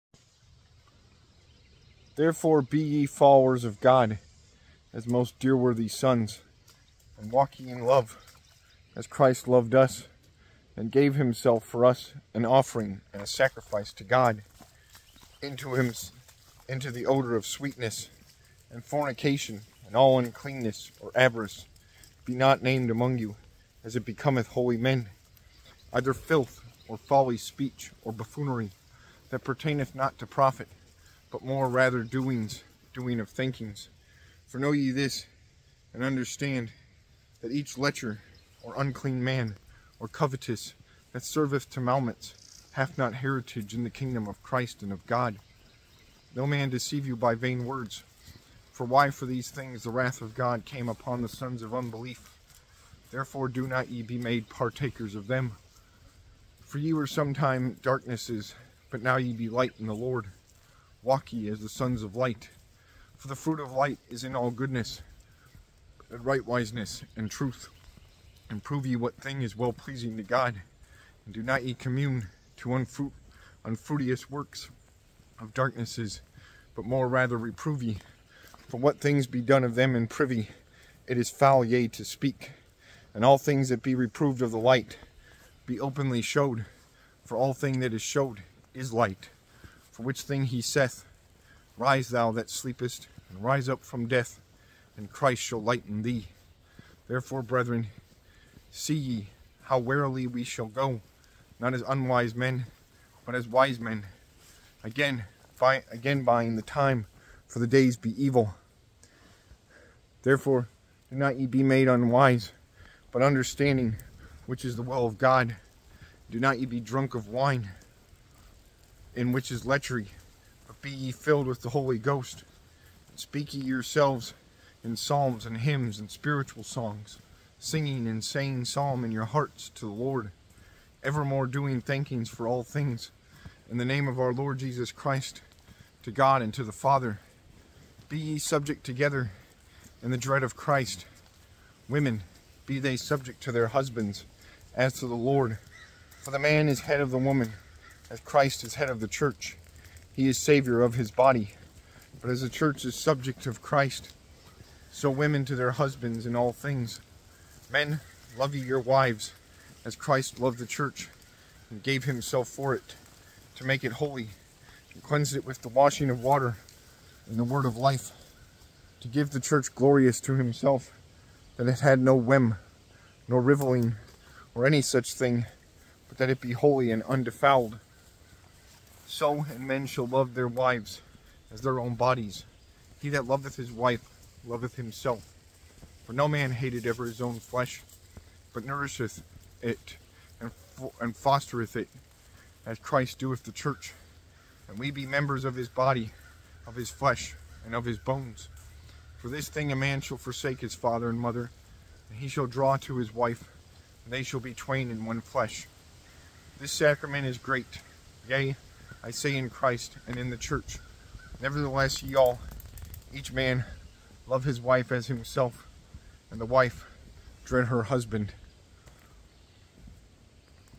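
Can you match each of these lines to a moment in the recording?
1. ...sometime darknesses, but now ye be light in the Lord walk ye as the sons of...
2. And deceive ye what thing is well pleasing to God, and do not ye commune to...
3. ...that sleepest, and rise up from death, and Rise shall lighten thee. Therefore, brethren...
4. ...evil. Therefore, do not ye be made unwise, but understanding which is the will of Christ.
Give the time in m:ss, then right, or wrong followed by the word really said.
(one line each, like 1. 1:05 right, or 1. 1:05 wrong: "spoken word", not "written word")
1. 0:57 right
2. 1:08 wrong: "prove", not "deceive"
3. 1:32 wrong: "Christ", not "Rise"
4. 1:48 wrong: "God", not "Christ".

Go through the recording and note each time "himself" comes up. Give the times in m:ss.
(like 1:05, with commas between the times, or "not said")
0:11, 2:42, 2:50, 3:04, 3:35.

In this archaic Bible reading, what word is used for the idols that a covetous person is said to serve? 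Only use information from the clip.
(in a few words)
maumets.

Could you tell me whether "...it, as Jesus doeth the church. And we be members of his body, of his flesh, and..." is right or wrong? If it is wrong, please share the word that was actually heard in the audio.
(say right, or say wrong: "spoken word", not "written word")
wrong: "Christ", not "Jesus".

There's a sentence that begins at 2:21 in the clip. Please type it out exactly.
Women, be they subject to their husbands, as to the Lord.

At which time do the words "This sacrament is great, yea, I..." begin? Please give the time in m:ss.
3:26.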